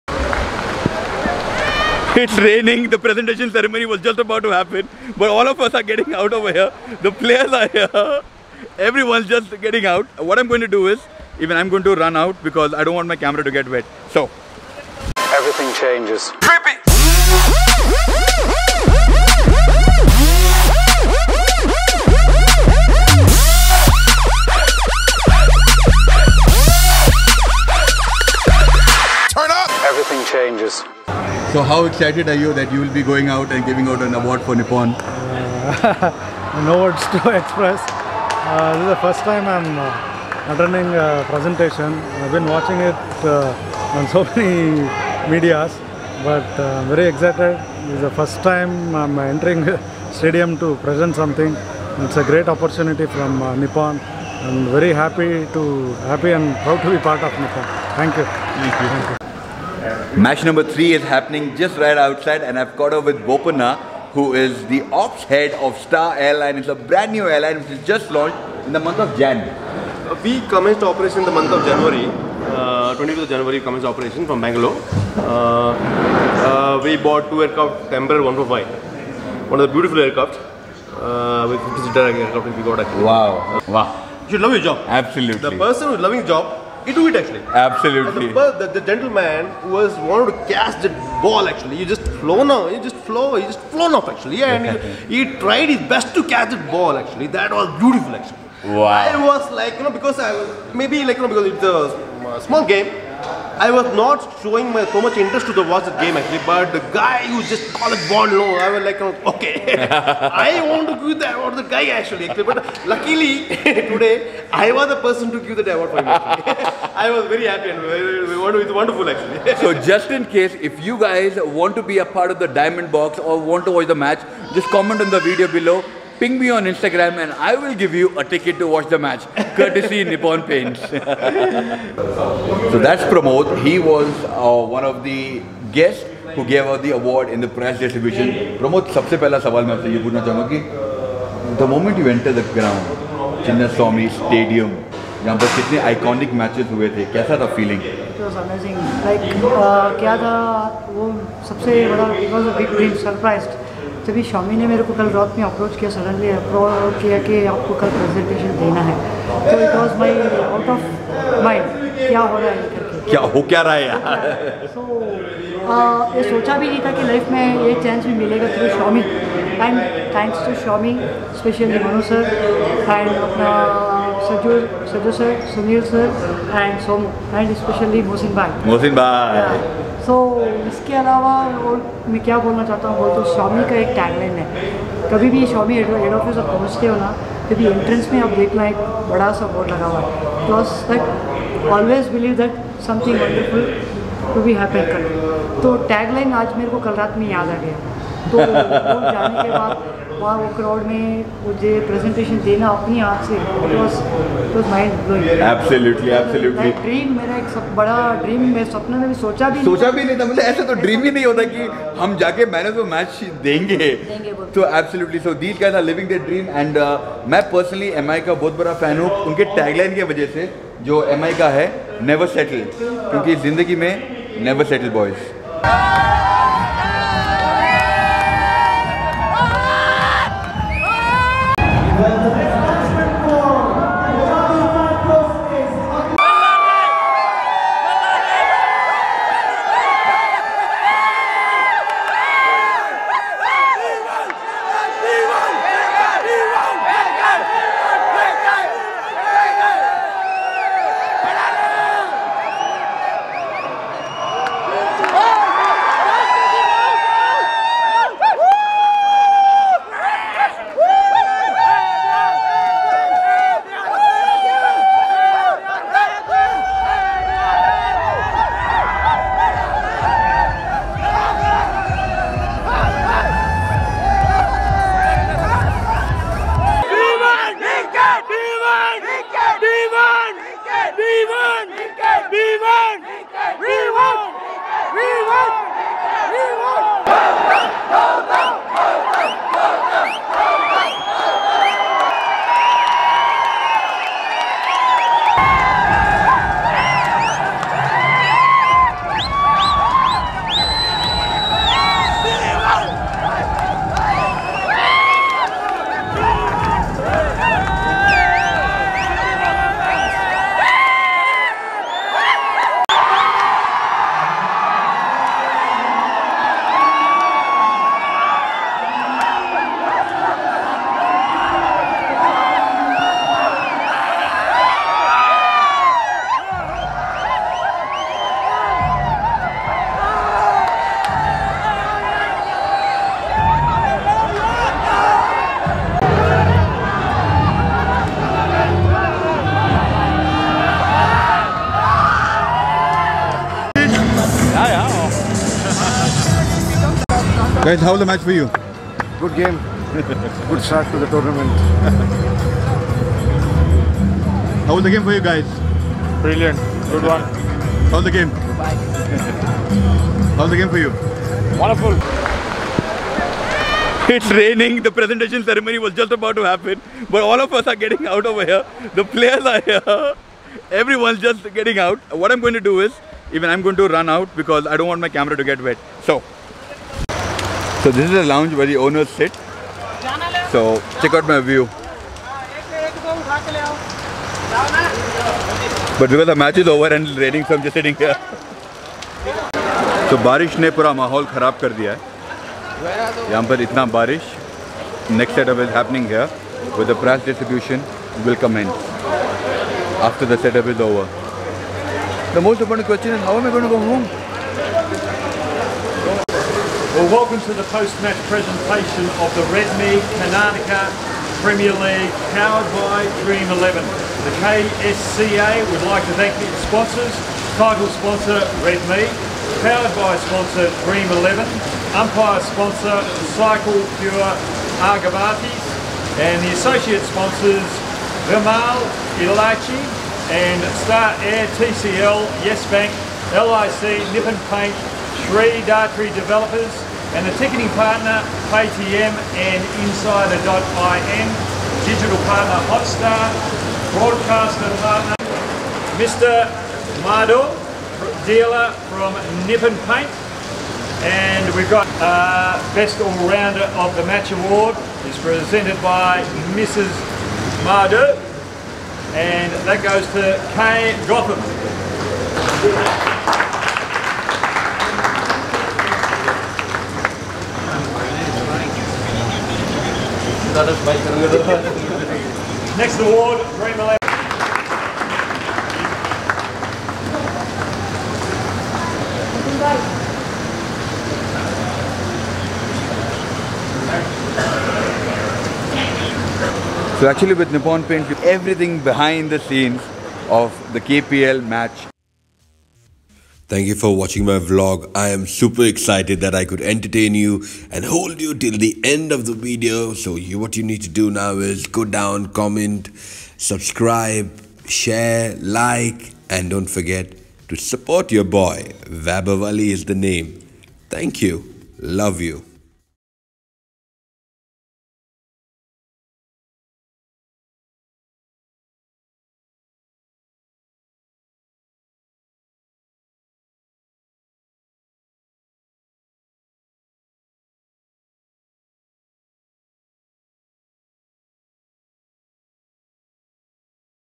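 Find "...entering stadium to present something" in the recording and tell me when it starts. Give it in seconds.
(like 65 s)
49 s.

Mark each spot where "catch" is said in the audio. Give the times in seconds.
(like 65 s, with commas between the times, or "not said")
90 s, 96 s.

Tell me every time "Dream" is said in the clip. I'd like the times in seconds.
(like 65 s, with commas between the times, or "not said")
413 s, 420 s.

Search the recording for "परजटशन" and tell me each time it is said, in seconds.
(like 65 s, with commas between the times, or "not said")
157 s, 201 s.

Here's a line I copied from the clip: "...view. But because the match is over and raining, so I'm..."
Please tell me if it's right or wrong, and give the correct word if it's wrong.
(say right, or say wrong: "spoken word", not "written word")
right.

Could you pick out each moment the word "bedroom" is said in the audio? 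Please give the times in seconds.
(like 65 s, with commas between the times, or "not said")
not said.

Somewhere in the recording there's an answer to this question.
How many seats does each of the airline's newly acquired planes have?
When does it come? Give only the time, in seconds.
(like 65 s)
81 s.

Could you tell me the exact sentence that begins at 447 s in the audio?
Mardor, dealer from Nippon Paint and we've got uh, Best All-Rounder of the Match Award is presented by Mrs.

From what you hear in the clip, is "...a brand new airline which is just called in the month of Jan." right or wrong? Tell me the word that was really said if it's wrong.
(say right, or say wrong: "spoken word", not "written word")
wrong: "launched", not "called".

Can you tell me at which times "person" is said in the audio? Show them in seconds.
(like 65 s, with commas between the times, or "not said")
85 s, 115 s.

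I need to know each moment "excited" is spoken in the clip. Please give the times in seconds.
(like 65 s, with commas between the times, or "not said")
31 s, 47 s, 495 s.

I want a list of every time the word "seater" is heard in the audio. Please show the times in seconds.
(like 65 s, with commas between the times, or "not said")
81 s.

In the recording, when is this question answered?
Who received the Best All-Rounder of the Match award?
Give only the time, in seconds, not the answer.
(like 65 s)
460 s.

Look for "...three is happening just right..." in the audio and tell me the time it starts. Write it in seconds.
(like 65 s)
60 s.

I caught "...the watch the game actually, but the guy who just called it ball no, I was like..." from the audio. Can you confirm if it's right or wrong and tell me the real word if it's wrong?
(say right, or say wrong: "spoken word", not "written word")
right.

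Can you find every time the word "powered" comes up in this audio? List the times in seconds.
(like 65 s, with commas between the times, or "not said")
412 s, 419 s.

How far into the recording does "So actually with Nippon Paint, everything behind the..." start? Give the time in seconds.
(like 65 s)
486 s.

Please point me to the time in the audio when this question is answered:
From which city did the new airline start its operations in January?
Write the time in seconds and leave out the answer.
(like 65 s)
74 s.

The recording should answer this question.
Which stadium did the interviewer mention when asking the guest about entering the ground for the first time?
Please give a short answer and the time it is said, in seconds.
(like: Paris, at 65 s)
Chinnaswamy Stadium, at 143 s.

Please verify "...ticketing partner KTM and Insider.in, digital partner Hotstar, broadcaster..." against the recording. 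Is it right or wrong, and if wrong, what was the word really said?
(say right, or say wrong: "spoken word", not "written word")
right.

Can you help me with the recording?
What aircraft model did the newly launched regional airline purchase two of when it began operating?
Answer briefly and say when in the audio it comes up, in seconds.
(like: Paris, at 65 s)
Embraer 145, at 77 s.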